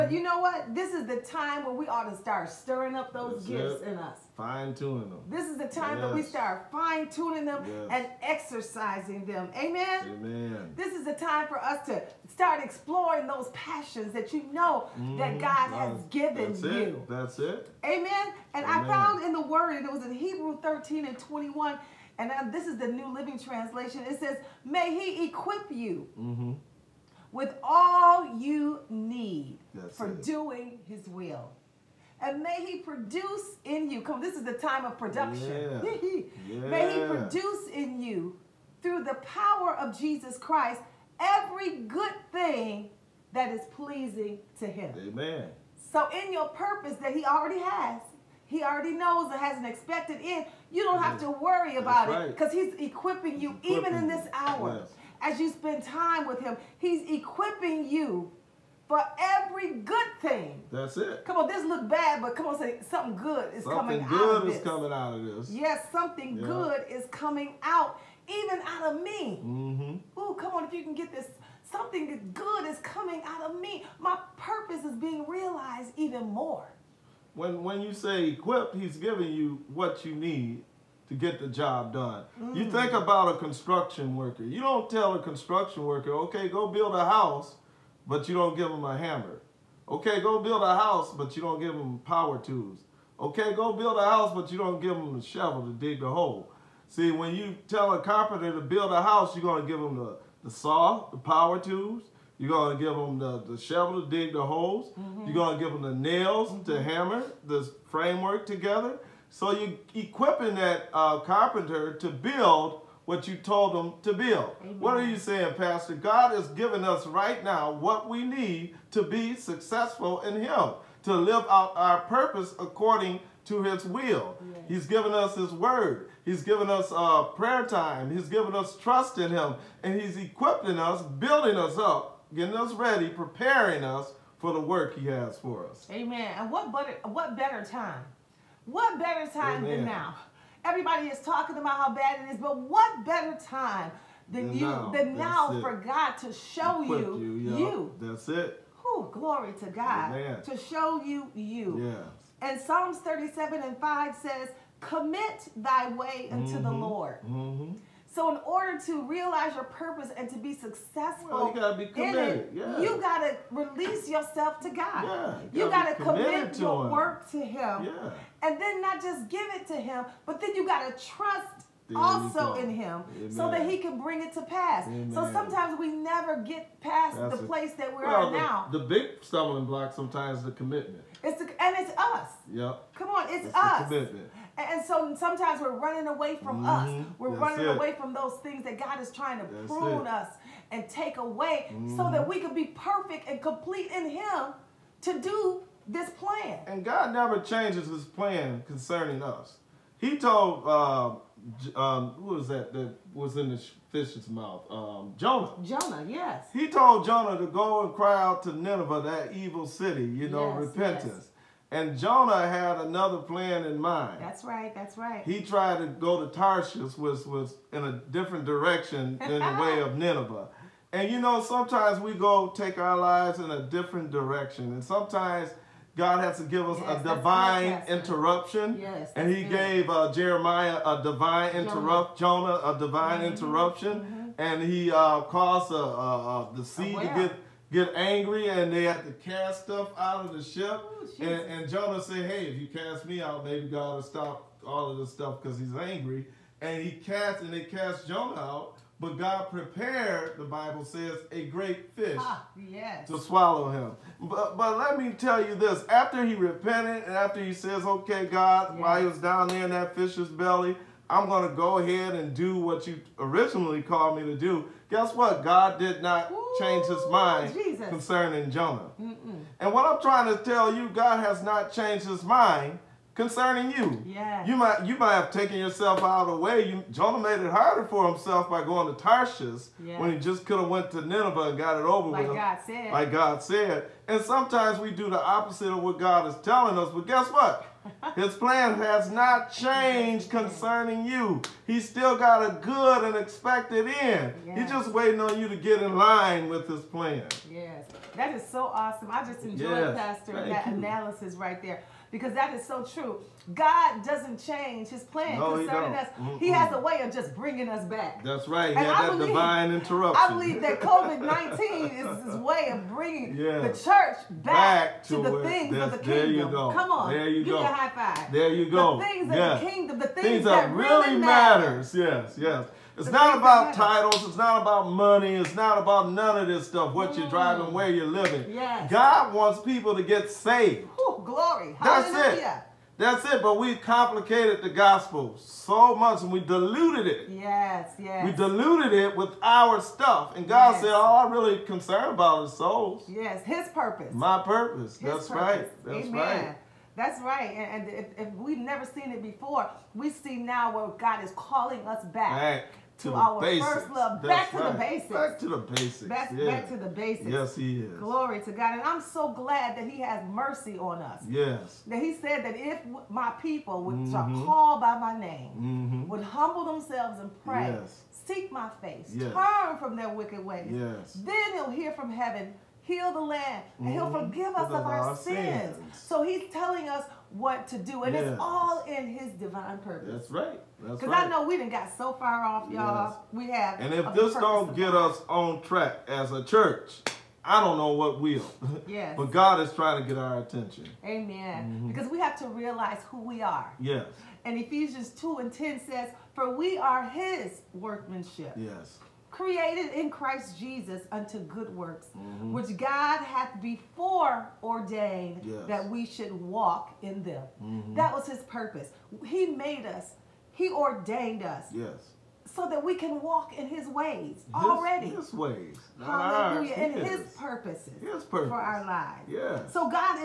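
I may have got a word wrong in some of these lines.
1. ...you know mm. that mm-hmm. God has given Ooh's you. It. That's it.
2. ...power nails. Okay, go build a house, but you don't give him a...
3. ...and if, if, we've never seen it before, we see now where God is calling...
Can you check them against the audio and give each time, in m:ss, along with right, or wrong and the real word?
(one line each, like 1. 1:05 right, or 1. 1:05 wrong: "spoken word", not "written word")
1. 0:14 wrong: "That", not "Ooh"
2. 1:31 wrong: "tools", not "nails"
3. 5:47 right.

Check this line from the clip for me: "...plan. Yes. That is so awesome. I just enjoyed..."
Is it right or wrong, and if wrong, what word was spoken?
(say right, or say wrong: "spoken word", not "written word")
right.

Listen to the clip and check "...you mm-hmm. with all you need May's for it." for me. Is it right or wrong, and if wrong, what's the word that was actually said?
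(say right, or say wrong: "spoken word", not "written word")
wrong: "That", not "May".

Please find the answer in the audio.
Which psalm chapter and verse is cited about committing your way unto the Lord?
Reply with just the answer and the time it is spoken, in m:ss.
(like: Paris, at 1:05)
Psalms 37:5, at 2:32.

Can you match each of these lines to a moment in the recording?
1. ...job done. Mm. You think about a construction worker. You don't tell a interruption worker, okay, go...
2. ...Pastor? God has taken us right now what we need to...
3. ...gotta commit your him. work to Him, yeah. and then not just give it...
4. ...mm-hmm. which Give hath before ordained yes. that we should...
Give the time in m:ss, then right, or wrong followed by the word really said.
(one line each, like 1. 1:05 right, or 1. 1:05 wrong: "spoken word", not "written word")
1. 1:21 wrong: "construction", not "interruption"
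2. 1:55 wrong: "given", not "taken"
3. 2:46 right
4. 6:42 wrong: "God", not "Give".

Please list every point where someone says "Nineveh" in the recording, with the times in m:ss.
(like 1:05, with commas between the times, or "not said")
3:28, 3:39, 4:41.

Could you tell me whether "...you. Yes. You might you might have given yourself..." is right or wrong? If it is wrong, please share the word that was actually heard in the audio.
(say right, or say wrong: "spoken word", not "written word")
wrong: "taken", not "given".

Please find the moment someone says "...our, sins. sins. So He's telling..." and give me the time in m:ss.
6:14.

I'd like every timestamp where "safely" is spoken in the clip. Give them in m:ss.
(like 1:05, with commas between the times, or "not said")
not said.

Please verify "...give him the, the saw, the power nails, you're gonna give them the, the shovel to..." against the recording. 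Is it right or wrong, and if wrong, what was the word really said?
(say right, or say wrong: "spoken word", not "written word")
wrong: "tools", not "nails".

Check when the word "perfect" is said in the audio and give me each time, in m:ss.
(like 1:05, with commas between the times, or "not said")
3:12.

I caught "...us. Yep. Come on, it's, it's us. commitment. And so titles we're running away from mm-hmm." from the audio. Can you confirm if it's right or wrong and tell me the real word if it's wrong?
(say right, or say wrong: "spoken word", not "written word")
wrong: "sometimes", not "titles".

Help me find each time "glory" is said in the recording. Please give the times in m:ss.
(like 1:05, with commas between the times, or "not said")
2:29, 5:31, 5:57.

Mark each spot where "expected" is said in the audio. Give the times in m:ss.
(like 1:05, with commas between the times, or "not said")
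0:49, 4:53.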